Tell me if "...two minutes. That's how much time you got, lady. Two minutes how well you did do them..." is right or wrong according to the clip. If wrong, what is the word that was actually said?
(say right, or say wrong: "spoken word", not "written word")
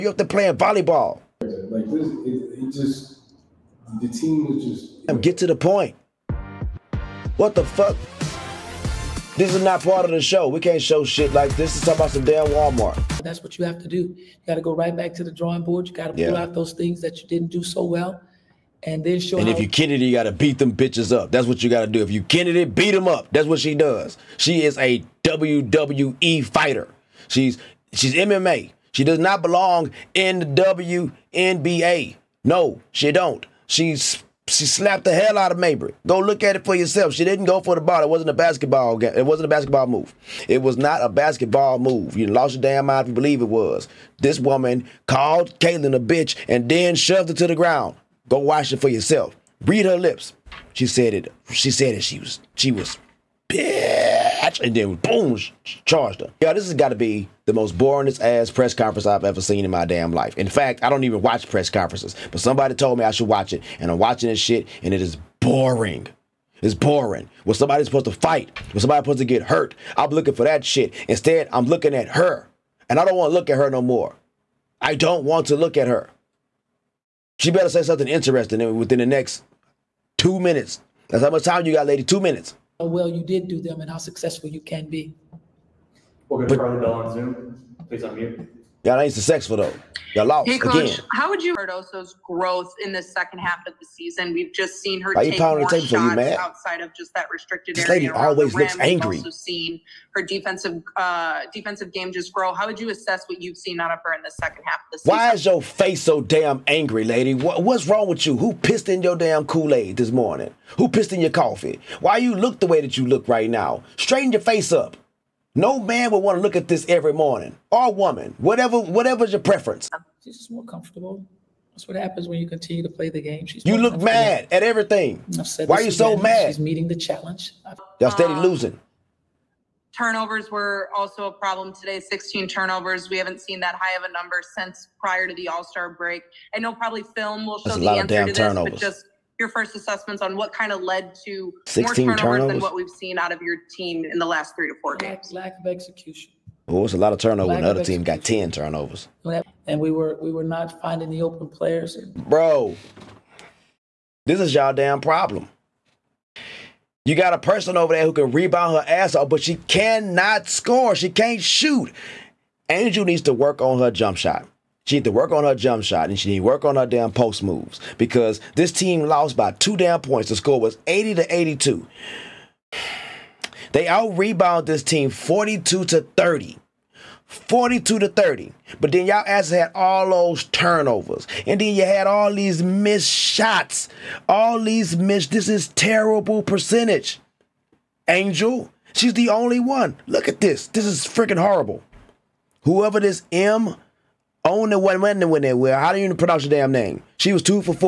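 right.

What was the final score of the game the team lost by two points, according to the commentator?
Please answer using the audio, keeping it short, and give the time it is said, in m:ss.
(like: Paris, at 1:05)
80 to 82, at 2:50.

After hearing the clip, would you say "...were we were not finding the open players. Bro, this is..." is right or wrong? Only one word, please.
right.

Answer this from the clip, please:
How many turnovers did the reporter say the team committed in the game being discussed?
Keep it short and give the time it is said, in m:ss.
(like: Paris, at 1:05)
16, at 2:11.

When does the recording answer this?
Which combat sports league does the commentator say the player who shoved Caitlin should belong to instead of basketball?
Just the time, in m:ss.
0:25.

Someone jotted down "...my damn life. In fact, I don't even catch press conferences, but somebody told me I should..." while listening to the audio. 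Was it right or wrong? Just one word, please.
wrong.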